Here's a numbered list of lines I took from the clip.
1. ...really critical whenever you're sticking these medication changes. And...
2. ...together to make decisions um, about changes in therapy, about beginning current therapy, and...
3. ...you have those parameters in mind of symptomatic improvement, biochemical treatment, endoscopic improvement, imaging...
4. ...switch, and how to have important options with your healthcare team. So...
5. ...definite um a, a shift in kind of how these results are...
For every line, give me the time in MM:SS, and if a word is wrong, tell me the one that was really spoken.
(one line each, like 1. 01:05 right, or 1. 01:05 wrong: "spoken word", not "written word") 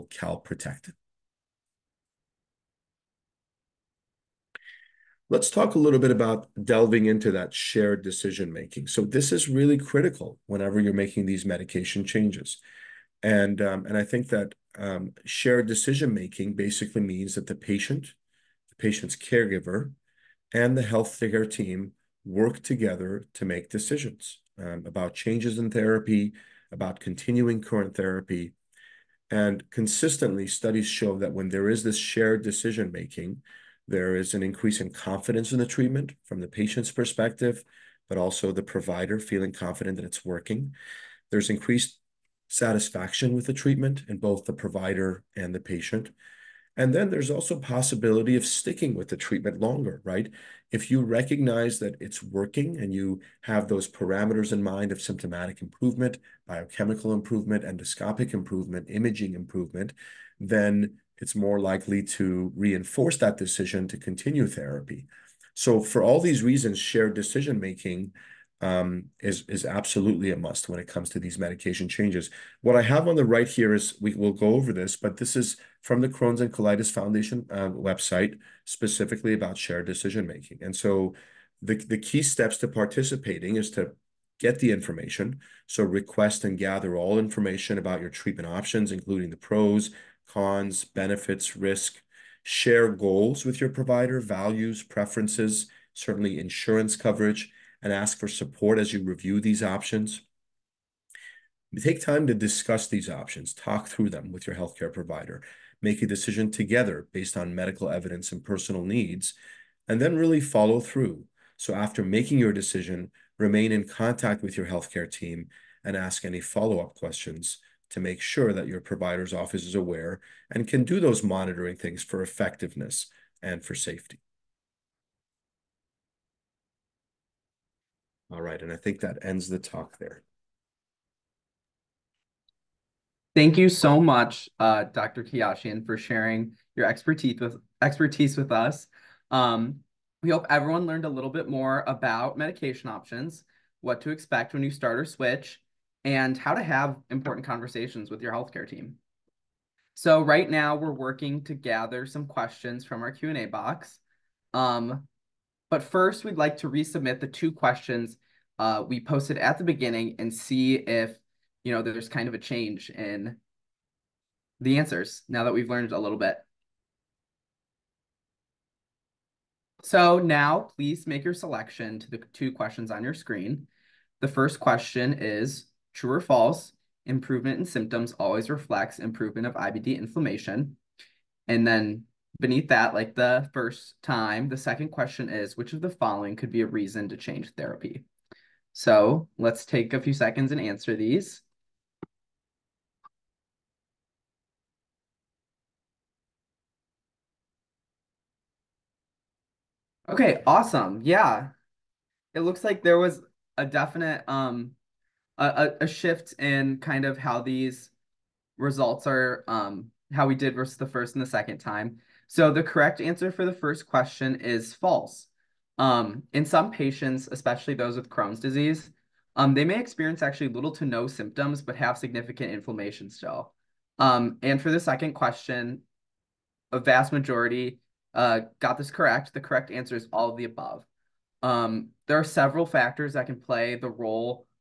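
1. 00:09 wrong: "making", not "sticking"
2. 00:22 wrong: "continuing", not "beginning"
3. 00:52 wrong: "improvement", not "treatment"
4. 02:25 wrong: "conversations", not "options"
5. 03:23 right.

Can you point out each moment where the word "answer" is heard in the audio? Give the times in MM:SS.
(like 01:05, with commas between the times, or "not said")
02:44, 03:10, 03:33, 03:49.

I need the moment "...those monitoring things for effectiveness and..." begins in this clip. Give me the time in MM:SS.
02:00.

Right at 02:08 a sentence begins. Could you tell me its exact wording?
All right, and I think that ends the talk there.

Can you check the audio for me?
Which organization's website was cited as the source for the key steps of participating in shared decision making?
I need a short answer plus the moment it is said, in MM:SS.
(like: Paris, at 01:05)
Crohn's and Colitis Foundation, at 01:16.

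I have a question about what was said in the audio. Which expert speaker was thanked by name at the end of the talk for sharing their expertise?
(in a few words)
Dr. Keyashian.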